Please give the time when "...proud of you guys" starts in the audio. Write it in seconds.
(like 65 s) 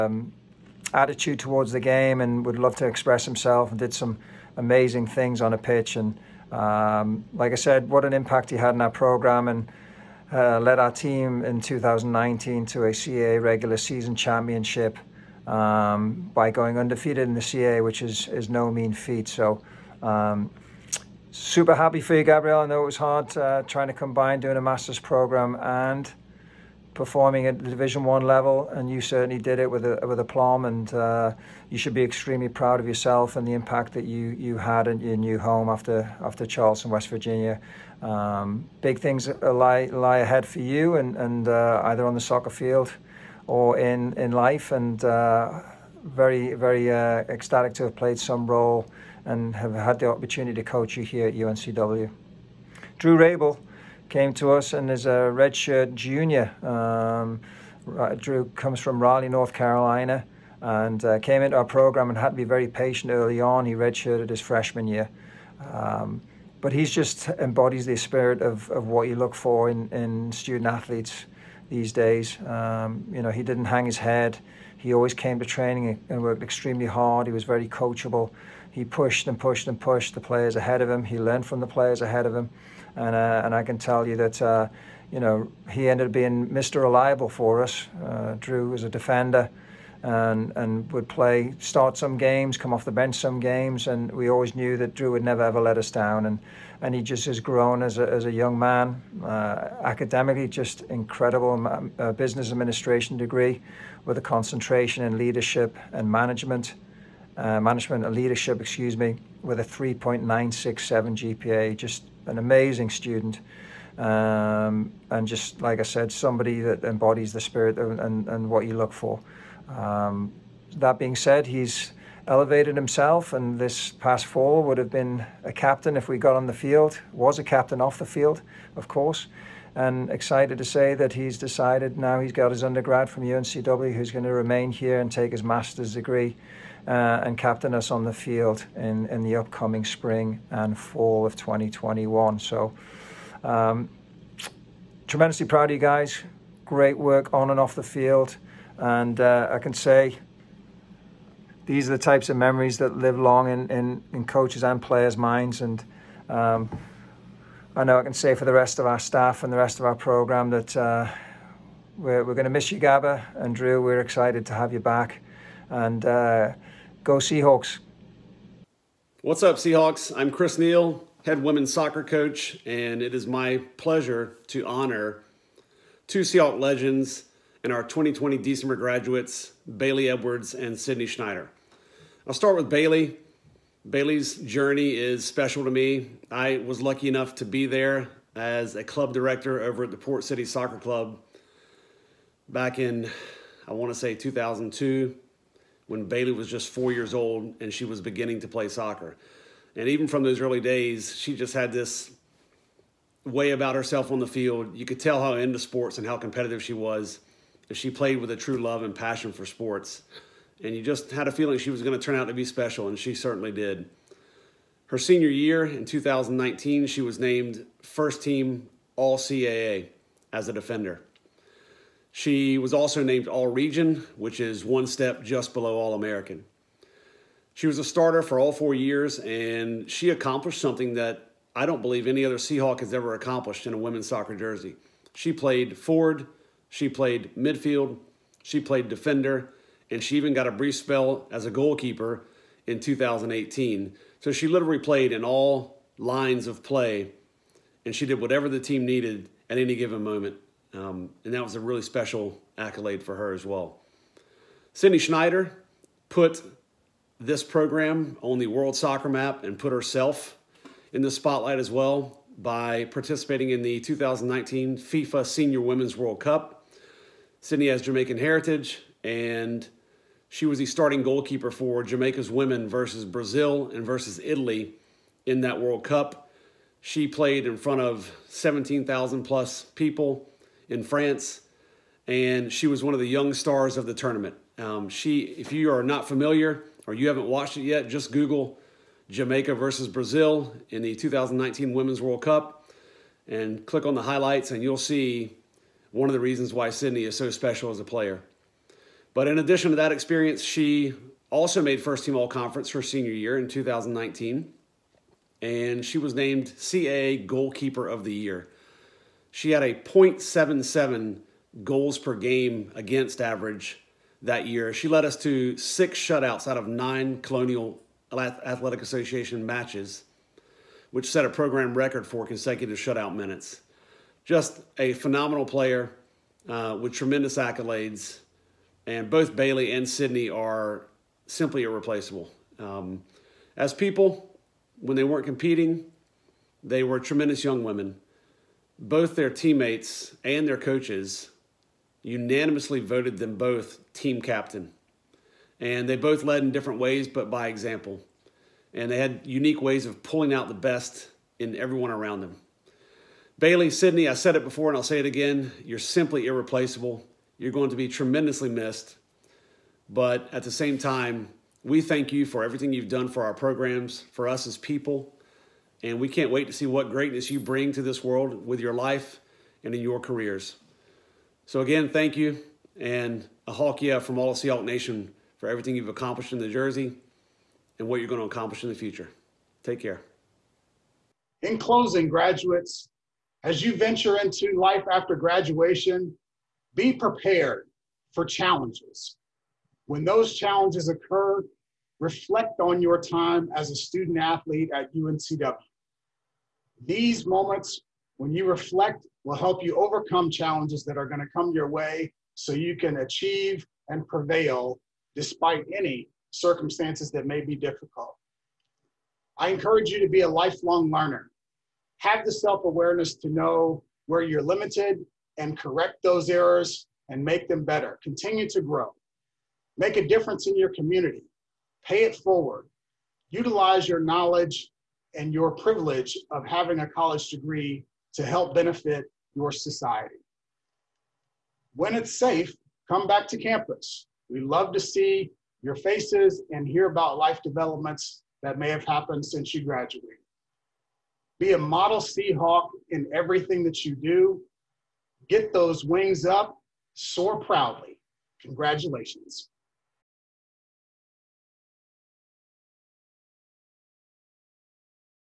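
145 s.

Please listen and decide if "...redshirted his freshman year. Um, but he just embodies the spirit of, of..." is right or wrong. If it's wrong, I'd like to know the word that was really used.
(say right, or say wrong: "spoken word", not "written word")
right.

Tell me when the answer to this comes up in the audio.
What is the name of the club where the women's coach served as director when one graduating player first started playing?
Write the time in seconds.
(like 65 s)
189 s.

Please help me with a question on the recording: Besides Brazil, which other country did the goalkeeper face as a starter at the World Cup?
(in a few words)
Italy.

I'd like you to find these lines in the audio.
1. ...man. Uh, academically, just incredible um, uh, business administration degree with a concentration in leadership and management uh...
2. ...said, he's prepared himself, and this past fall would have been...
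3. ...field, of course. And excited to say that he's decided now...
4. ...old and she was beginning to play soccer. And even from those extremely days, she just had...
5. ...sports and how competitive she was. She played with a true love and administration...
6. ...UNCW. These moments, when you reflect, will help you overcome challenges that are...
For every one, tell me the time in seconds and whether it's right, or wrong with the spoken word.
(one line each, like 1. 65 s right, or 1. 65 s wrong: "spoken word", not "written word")
1. 98 s right
2. 121 s wrong: "elevated", not "prepared"
3. 128 s right
4. 197 s wrong: "early", not "extremely"
5. 205 s wrong: "passion", not "administration"
6. 394 s right.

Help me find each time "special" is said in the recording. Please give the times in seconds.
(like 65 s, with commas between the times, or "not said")
185 s, 212 s, 251 s, 297 s.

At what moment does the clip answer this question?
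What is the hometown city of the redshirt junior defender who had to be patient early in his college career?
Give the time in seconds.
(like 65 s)
59 s.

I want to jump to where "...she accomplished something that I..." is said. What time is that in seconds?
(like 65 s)
229 s.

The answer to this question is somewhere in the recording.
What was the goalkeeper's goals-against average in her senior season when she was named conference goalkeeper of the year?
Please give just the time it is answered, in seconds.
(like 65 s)
309 s.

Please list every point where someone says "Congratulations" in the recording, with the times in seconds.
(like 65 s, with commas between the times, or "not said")
448 s.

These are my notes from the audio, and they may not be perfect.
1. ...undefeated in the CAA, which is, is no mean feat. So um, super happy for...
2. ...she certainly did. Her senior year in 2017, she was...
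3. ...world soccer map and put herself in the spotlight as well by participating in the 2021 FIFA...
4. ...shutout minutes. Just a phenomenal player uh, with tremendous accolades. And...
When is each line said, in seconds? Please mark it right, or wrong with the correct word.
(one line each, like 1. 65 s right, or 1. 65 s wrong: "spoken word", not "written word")
1. 16 s right
2. 212 s wrong: "2019", not "2017"
3. 258 s wrong: "2019", not "2021"
4. 322 s right.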